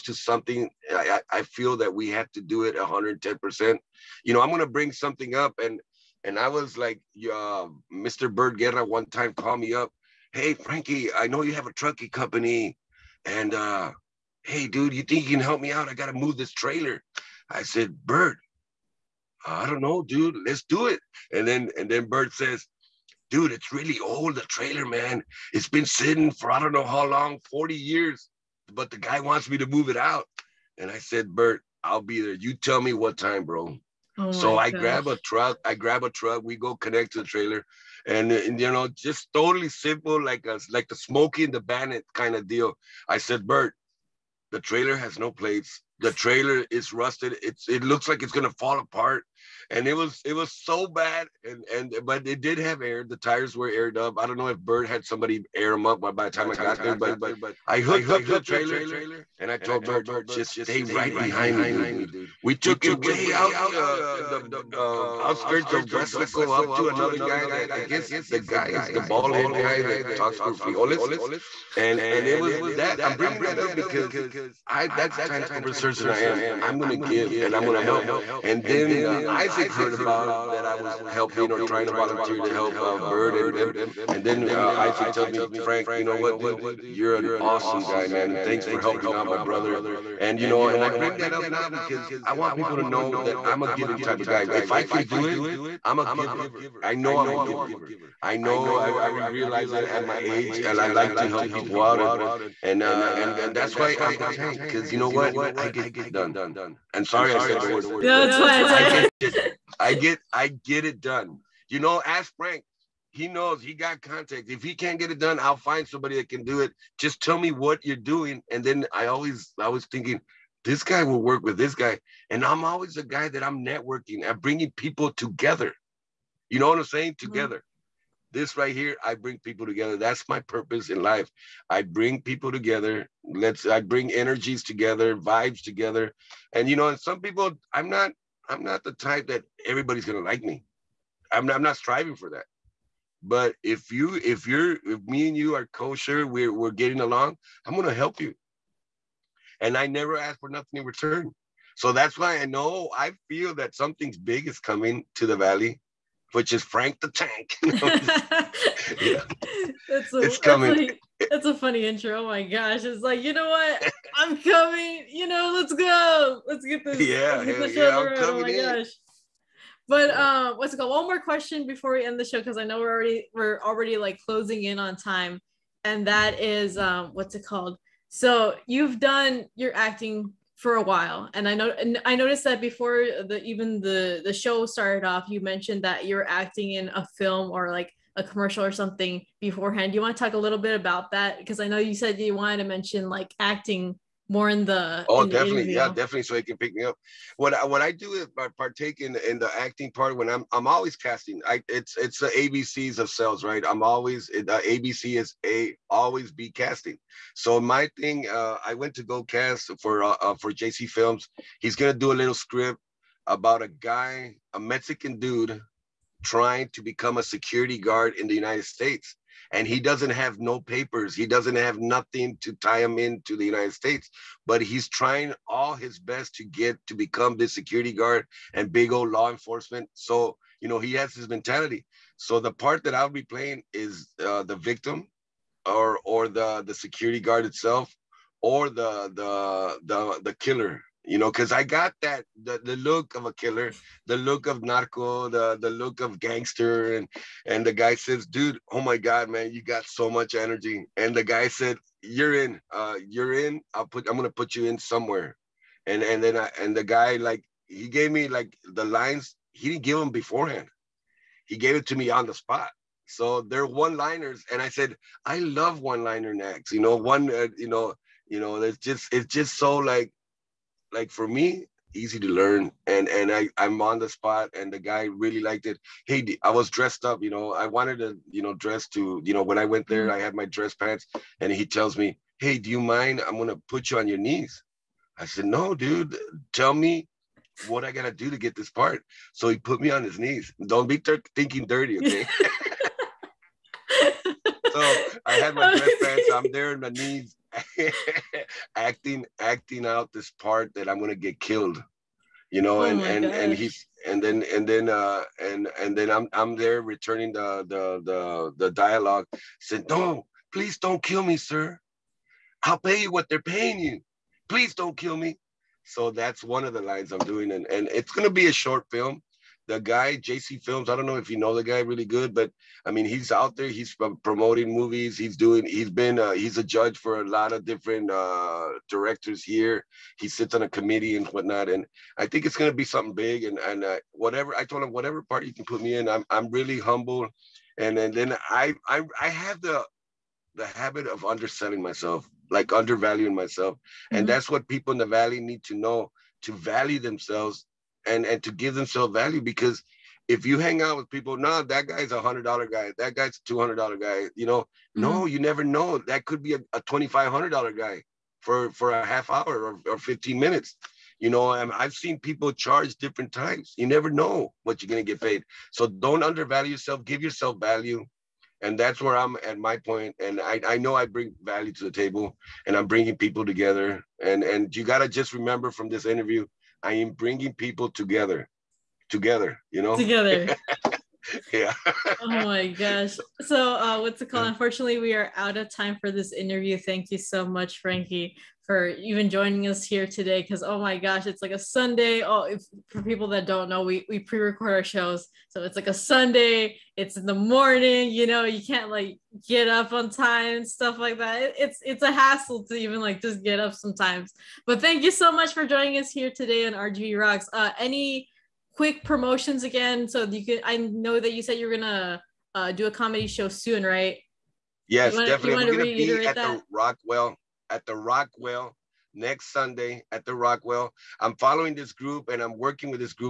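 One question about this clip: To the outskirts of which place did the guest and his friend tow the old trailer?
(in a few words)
Westlake.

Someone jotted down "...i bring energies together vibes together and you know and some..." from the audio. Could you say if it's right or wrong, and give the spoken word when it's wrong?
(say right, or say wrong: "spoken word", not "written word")
right.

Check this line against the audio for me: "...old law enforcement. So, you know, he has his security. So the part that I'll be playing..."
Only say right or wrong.
wrong.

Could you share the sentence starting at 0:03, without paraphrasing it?
percent You know, I'm gonna bring something up, and and I was like, uh, Mr.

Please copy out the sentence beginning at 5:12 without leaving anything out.
I'll pay you what they're paying you.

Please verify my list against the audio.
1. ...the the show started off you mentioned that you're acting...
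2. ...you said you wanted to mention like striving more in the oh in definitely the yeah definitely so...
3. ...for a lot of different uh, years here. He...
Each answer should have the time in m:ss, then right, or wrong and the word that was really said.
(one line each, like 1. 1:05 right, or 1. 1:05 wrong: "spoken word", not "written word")
1. 3:03 right
2. 3:11 wrong: "acting", not "striving"
3. 5:26 wrong: "directors", not "years".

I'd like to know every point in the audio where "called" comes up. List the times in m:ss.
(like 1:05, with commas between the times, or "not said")
0:09, 2:50, 2:57, 6:24.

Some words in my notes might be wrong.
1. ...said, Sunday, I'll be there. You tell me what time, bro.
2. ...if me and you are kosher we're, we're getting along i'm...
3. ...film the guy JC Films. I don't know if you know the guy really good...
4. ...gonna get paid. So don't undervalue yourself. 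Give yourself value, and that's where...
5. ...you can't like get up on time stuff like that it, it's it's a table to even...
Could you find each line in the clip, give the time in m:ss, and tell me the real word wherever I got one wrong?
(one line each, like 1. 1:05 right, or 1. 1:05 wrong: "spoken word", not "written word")
1. 0:30 wrong: "Bert", not "Sunday"
2. 2:24 right
3. 5:18 right
4. 6:04 right
5. 6:38 wrong: "hassle", not "table".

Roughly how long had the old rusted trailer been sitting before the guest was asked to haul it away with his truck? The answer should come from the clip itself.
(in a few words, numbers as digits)
40 years.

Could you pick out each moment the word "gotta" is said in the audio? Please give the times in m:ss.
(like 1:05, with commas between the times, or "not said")
4:47, 6:14.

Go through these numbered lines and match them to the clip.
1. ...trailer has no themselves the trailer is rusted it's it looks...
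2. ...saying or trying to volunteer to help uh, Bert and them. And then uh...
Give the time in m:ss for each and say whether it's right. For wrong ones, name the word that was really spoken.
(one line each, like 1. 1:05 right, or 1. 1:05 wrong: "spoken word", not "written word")
1. 0:44 wrong: "plates", not "themselves"
2. 1:21 wrong: "helping", not "saying".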